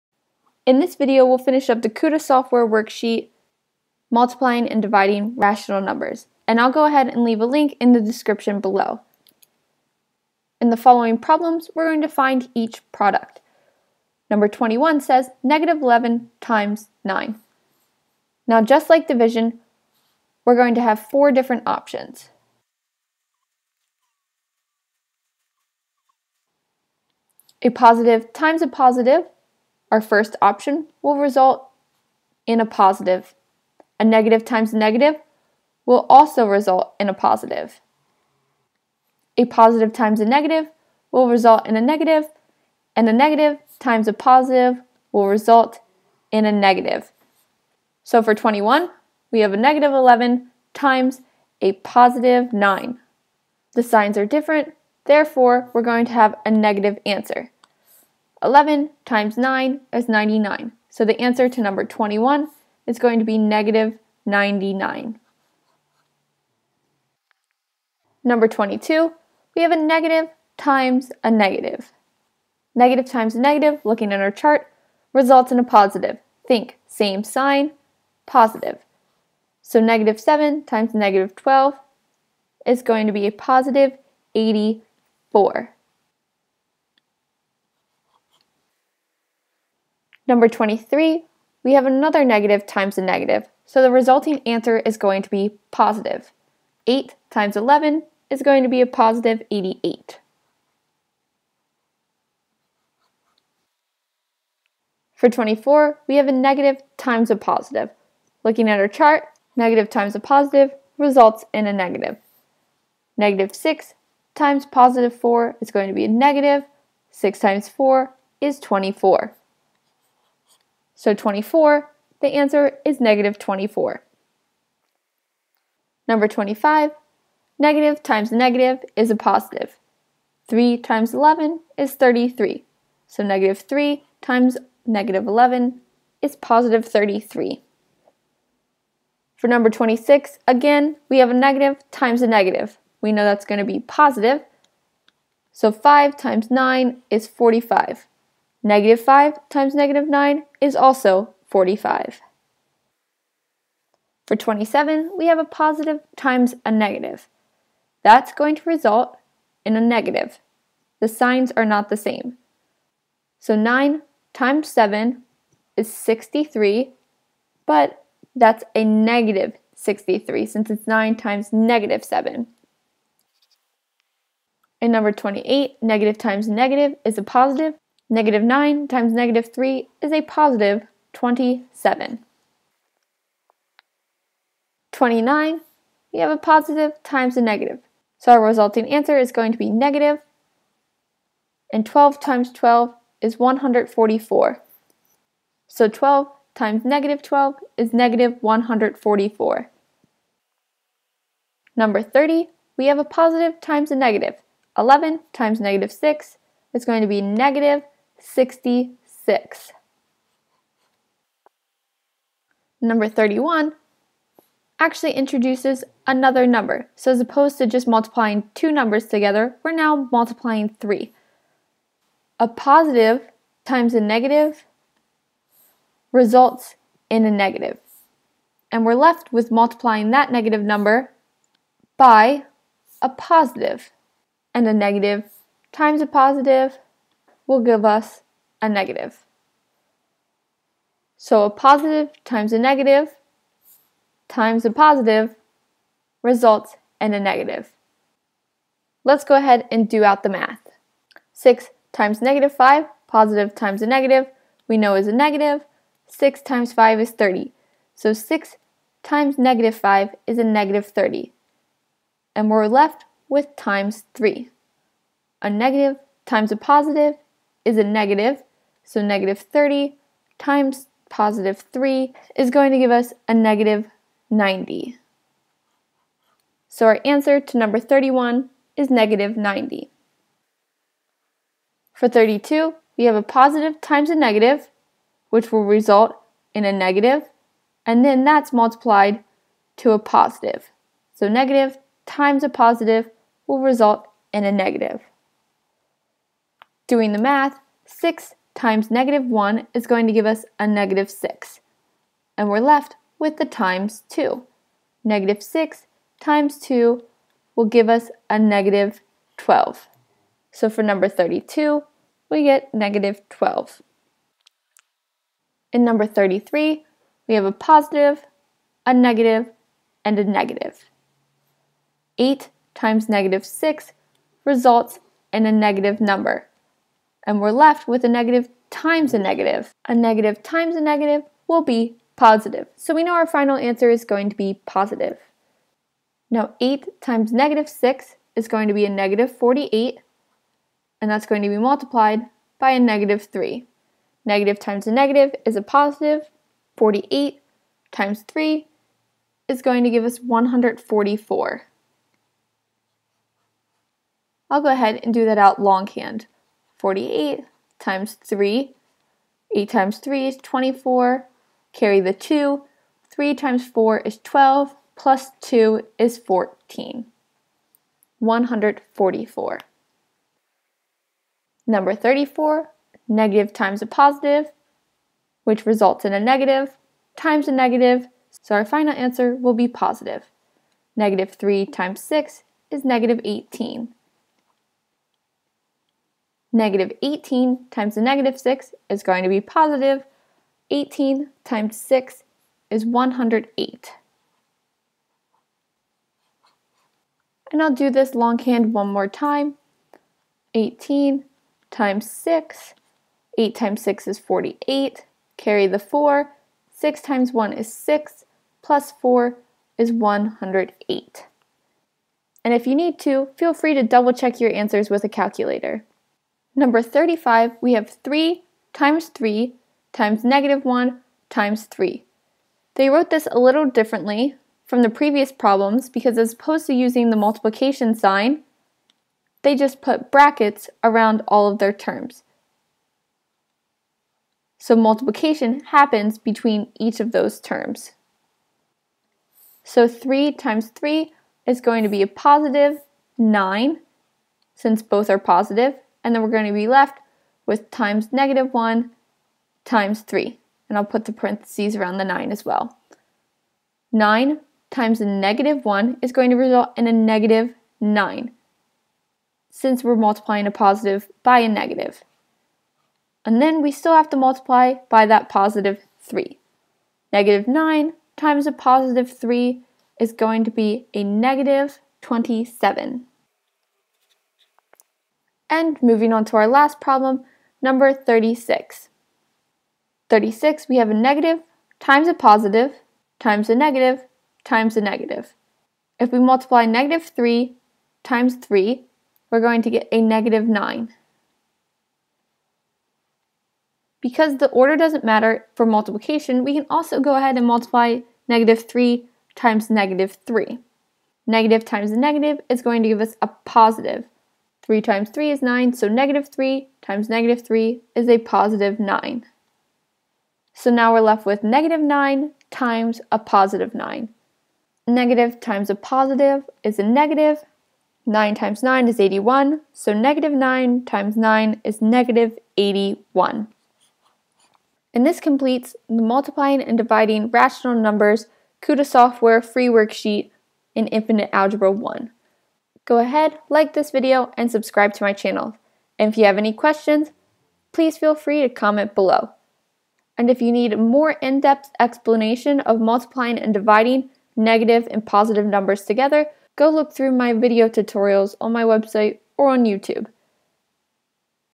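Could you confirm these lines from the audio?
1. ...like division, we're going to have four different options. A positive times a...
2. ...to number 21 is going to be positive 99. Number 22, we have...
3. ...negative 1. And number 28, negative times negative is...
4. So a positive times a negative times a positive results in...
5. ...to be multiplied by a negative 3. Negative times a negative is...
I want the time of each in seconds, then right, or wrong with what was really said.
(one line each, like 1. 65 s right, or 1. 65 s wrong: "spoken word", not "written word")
1. 18 s right
2. 61 s wrong: "negative", not "positive"
3. 171 s wrong: "7", not "1"
4. 241 s right
5. 341 s right.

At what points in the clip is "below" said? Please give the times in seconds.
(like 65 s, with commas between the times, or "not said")
8 s, 538 s.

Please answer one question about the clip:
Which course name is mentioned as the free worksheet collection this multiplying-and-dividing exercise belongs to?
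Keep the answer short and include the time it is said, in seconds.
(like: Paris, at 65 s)
Infinite Algebra 1, at 530 s.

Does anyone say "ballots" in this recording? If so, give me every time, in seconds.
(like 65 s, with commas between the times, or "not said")
not said.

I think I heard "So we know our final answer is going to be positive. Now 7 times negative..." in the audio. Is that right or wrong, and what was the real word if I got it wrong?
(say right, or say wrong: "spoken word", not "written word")
wrong: "8", not "7".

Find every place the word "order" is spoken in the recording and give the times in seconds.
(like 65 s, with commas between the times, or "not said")
494 s.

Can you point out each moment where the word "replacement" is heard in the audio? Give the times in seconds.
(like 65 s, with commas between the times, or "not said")
not said.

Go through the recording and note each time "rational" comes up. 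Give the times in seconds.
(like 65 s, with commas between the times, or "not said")
5 s, 527 s.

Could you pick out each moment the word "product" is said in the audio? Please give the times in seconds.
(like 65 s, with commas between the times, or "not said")
12 s.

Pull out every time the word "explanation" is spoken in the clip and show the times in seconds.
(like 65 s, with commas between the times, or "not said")
541 s.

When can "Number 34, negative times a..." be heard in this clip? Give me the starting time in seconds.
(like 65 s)
371 s.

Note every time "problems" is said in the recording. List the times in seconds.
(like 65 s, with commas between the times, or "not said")
11 s, 425 s, 476 s.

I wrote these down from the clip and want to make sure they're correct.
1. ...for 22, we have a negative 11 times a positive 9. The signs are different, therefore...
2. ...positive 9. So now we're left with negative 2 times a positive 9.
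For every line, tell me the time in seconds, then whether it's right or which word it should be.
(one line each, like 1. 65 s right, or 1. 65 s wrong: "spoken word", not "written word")
1. 48 s wrong: "21", not "22"
2. 508 s wrong: "9", not "2".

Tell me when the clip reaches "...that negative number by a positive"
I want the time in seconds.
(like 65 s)
230 s.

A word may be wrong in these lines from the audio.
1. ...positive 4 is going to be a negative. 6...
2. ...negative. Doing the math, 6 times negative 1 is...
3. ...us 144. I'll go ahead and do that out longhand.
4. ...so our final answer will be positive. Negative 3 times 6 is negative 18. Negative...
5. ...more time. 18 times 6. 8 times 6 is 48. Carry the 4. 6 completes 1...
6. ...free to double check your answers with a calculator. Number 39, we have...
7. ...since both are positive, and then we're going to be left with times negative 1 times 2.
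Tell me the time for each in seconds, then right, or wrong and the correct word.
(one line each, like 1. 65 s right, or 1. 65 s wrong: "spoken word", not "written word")
1. 114 s right
2. 294 s right
3. 350 s right
4. 378 s right
5. 398 s wrong: "times", not "completes"
6. 413 s wrong: "35", not "39"
7. 444 s wrong: "3", not "2".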